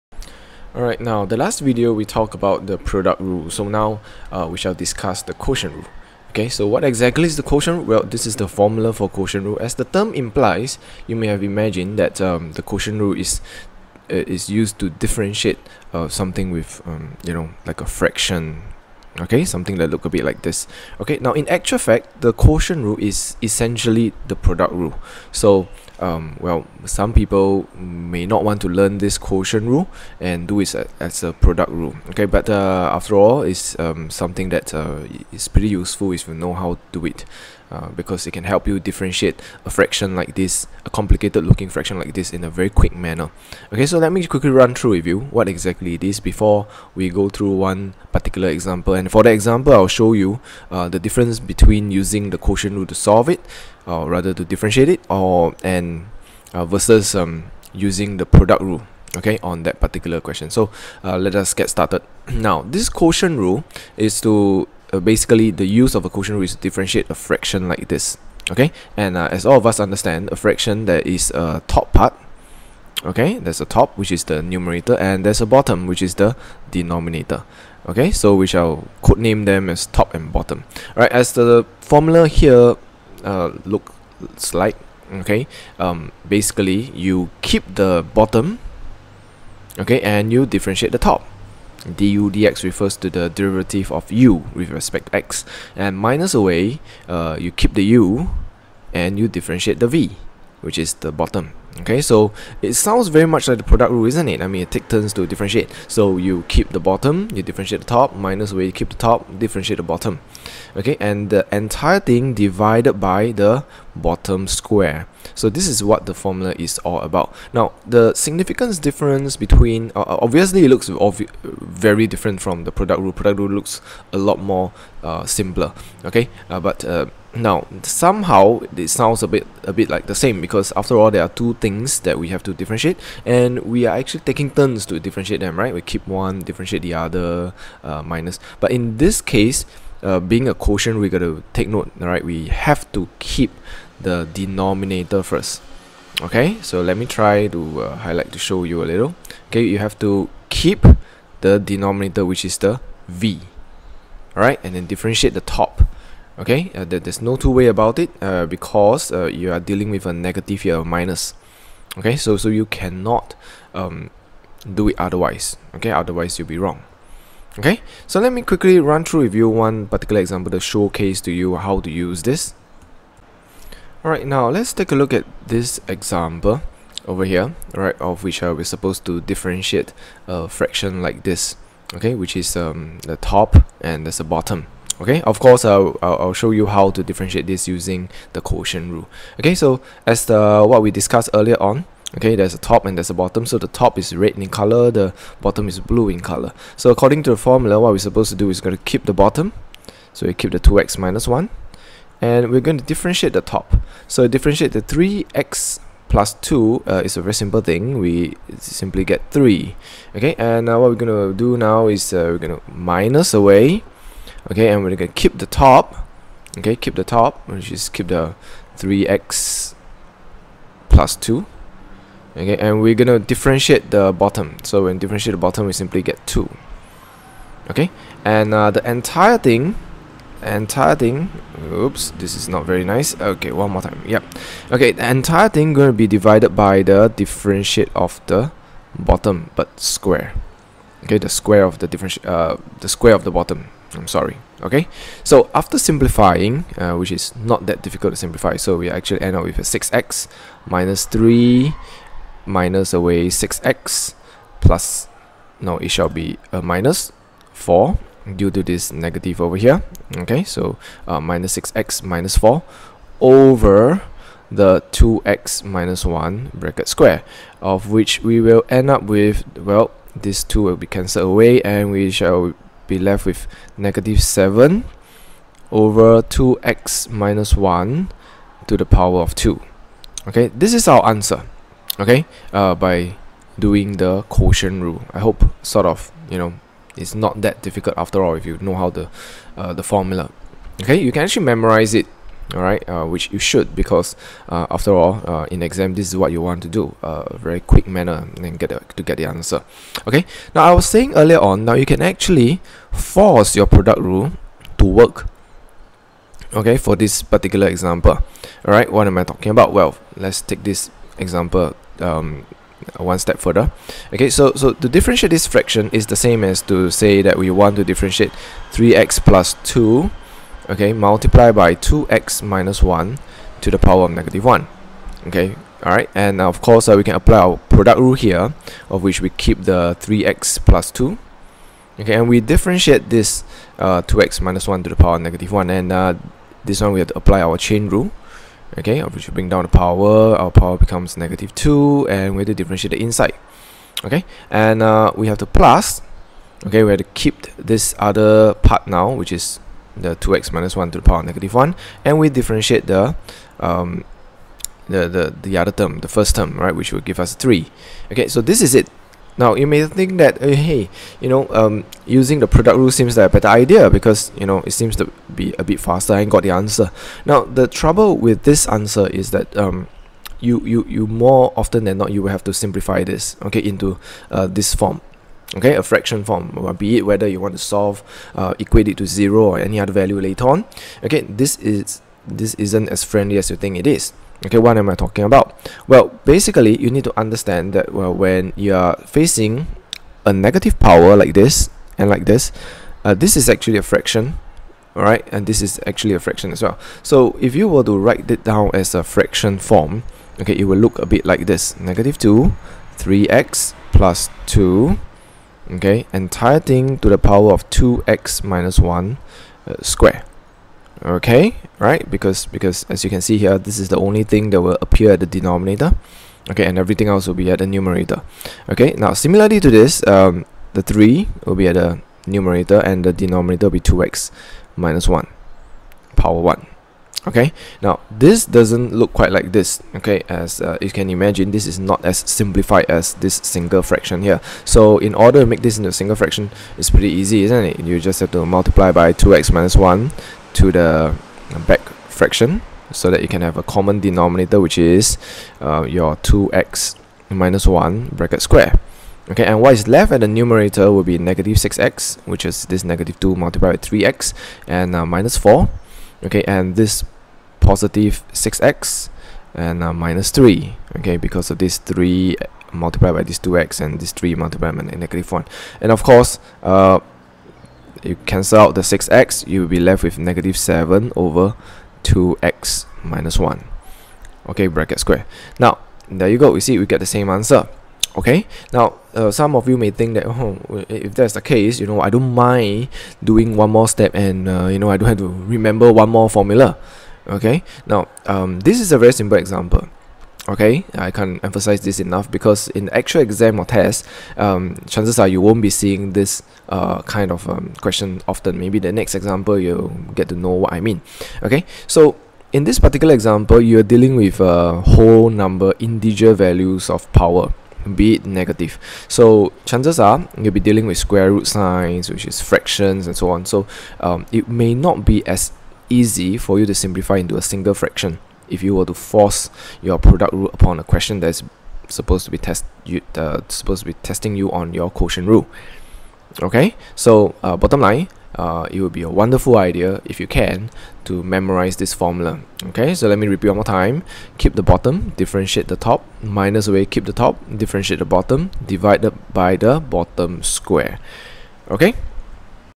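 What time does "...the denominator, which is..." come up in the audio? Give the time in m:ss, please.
2:31.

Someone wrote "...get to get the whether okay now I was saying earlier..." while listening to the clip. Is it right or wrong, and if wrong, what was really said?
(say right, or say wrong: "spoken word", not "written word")
wrong: "answer", not "whether".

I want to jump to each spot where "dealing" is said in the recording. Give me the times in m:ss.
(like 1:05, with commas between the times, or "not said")
2:39, 8:23, 8:30.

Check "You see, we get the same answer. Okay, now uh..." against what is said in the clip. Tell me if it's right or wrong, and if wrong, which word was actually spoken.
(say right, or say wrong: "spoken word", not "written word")
right.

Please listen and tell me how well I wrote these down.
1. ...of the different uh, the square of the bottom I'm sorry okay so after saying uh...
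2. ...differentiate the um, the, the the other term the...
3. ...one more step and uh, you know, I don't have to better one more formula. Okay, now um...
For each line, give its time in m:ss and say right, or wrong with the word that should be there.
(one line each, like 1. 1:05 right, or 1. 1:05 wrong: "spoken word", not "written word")
1. 4:01 wrong: "simplifying", not "saying"
2. 5:52 right
3. 8:03 wrong: "remember", not "better".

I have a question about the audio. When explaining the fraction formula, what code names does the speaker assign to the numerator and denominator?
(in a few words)
top and bottom.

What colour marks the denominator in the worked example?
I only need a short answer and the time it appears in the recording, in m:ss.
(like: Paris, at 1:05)
blue, at 3:15.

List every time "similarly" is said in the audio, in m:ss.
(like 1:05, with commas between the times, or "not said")
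6:59.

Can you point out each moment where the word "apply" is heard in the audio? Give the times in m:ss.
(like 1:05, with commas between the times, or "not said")
5:27, 5:37.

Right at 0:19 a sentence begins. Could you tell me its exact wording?
Okay, something that look a bit like this.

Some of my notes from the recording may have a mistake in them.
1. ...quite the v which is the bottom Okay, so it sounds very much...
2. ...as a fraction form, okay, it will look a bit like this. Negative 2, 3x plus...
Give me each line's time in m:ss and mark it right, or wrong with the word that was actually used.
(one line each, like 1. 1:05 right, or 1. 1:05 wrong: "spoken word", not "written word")
1. 1:39 wrong: "differentiate", not "quite"
2. 6:38 right.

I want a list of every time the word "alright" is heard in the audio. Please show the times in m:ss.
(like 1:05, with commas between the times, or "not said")
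0:00, 2:54, 5:25.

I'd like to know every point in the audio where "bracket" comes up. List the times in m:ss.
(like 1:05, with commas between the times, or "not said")
4:26, 7:28, 7:54.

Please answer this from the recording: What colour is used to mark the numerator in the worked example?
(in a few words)
red.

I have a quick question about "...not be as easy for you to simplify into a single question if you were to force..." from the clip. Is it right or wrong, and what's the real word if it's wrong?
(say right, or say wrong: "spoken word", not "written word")
wrong: "fraction", not "question".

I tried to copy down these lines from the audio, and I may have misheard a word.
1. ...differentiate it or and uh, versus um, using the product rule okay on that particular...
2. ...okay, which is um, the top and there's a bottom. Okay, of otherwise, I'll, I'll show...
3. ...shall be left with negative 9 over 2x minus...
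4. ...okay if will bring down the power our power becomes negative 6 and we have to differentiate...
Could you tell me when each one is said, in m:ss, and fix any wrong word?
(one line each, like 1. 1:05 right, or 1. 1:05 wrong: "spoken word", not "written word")
1. 0:54 right
2. 3:01 wrong: "course", not "otherwise"
3. 4:32 wrong: "7", not "9"
4. 5:38 wrong: "2", not "6".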